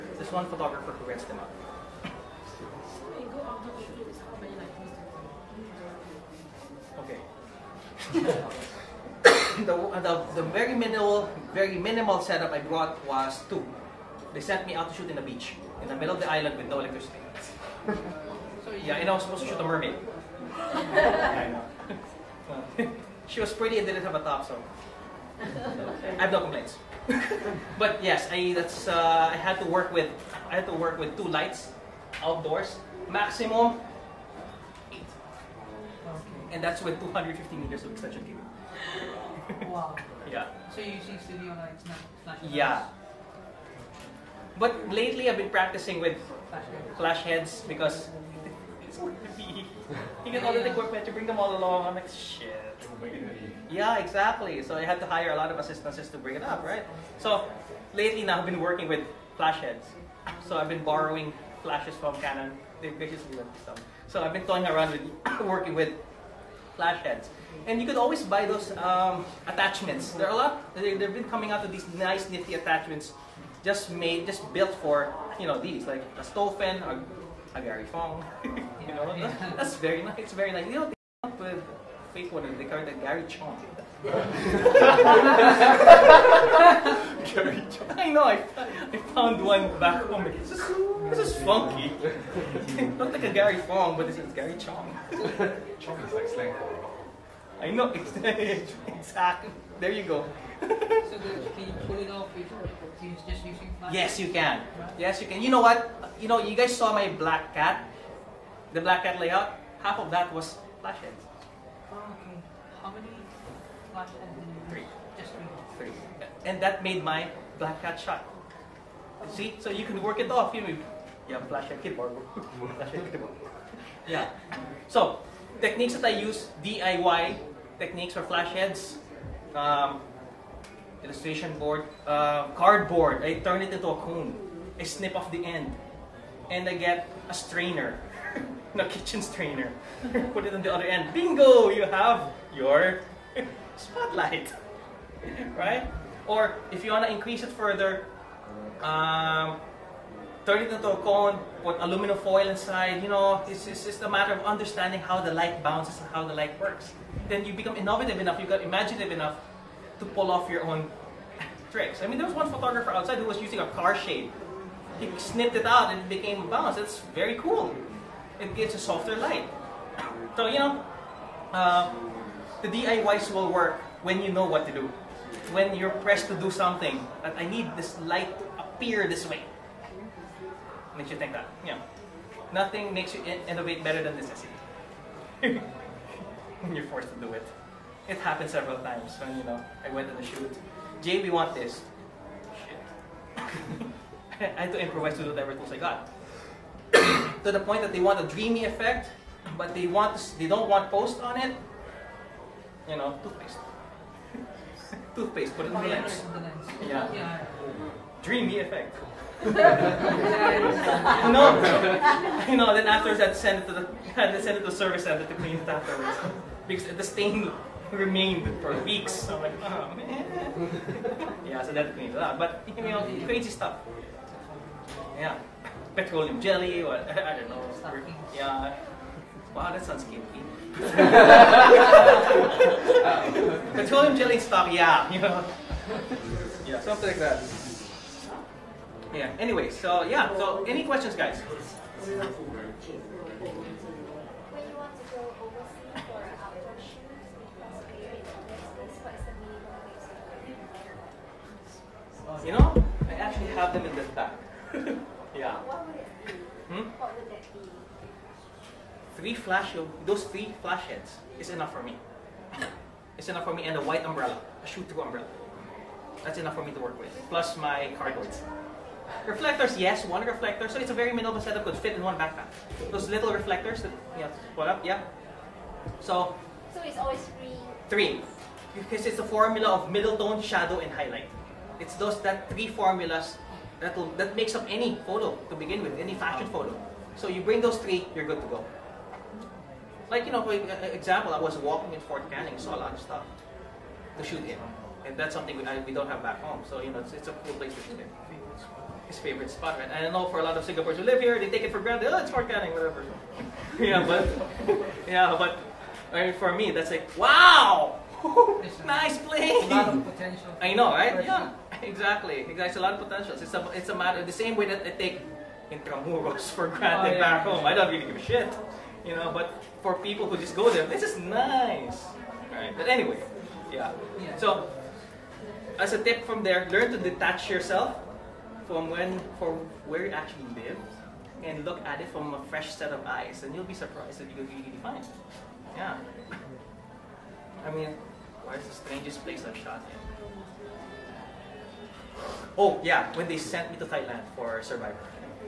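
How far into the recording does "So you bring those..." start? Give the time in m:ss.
4:47.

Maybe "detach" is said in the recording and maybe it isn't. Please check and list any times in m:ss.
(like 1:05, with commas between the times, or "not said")
5:26.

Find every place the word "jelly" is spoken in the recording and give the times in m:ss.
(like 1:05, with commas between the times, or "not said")
3:46, 3:54.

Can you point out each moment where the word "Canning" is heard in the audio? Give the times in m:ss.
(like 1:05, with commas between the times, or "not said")
4:52, 5:02.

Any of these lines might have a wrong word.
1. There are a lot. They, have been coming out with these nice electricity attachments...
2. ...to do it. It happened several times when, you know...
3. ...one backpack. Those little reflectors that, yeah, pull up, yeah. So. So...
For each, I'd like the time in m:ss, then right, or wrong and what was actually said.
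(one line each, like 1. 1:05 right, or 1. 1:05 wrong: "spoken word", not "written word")
1. 1:10 wrong: "nifty", not "electricity"
2. 3:07 right
3. 4:32 right.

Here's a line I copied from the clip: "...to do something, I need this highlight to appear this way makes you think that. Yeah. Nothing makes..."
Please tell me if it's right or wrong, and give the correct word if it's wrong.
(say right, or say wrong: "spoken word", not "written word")
wrong: "light", not "highlight".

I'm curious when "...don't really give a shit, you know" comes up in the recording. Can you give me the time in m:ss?
5:17.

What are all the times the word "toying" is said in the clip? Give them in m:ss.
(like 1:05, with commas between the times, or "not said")
1:04.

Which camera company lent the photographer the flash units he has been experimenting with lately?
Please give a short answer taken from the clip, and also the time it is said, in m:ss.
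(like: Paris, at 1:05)
Canon, at 1:02.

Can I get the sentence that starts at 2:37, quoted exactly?
Then you become innovative enough, you got imaginative enough to pull off your own tricks.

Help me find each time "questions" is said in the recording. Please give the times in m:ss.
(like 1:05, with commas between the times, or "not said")
4:00.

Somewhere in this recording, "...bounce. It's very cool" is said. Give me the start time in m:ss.
2:46.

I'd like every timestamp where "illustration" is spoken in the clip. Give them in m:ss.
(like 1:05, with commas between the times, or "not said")
2:11.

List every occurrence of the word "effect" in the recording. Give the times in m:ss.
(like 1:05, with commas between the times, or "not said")
3:18, 3:28.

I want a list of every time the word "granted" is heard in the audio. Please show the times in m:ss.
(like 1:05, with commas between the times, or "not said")
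5:01, 5:16.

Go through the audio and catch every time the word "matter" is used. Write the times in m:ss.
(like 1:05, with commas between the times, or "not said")
2:34, 5:13.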